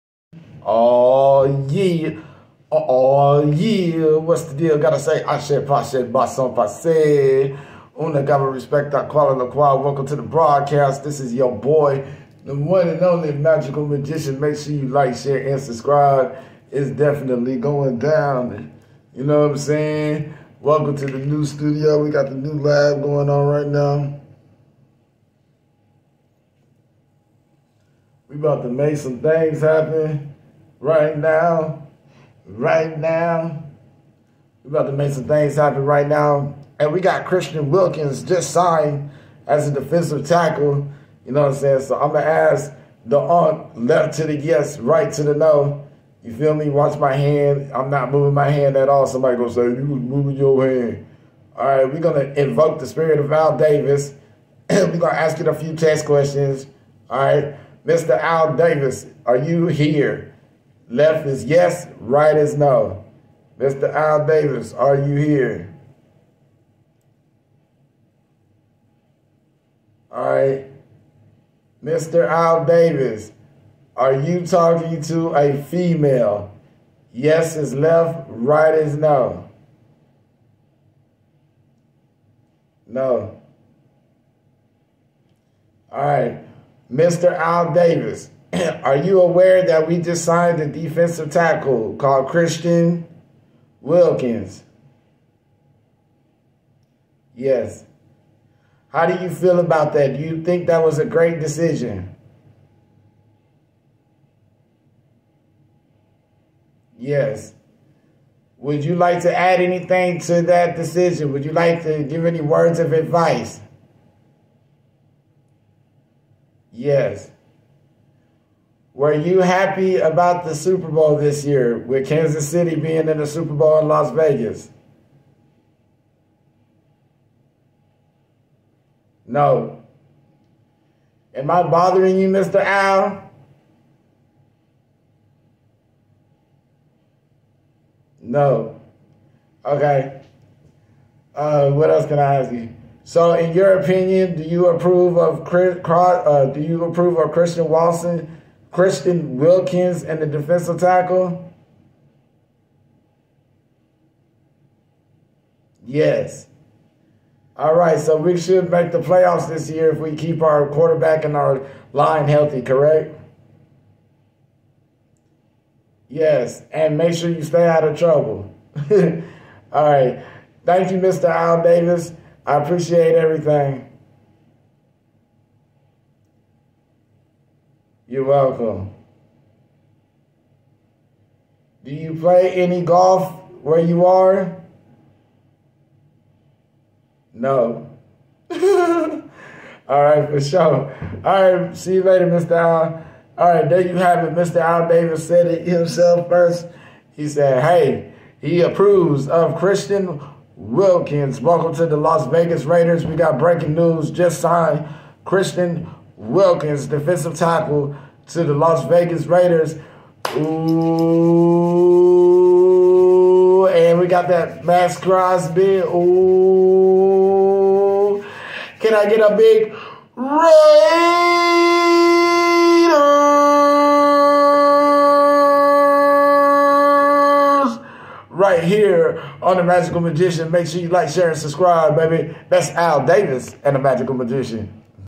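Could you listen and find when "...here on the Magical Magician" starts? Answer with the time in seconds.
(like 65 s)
228 s.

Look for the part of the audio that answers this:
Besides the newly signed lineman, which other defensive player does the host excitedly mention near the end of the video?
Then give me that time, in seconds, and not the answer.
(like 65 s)
214 s.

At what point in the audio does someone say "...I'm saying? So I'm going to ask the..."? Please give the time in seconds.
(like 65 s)
41 s.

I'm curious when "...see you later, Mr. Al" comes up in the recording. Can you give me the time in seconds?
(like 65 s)
191 s.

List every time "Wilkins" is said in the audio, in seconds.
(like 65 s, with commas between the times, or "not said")
37 s, 93 s, 149 s, 200 s, 206 s.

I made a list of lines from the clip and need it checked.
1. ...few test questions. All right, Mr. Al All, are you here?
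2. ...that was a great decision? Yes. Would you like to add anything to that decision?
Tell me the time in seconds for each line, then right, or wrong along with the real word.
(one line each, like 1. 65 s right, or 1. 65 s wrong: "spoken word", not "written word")
1. 55 s wrong: "Davis", not "All"
2. 100 s right.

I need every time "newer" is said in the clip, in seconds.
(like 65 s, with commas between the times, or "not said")
not said.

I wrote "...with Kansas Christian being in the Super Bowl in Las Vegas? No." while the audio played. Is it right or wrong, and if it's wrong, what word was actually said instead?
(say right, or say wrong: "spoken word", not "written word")
wrong: "City", not "Christian".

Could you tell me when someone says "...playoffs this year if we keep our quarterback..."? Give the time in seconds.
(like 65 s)
159 s.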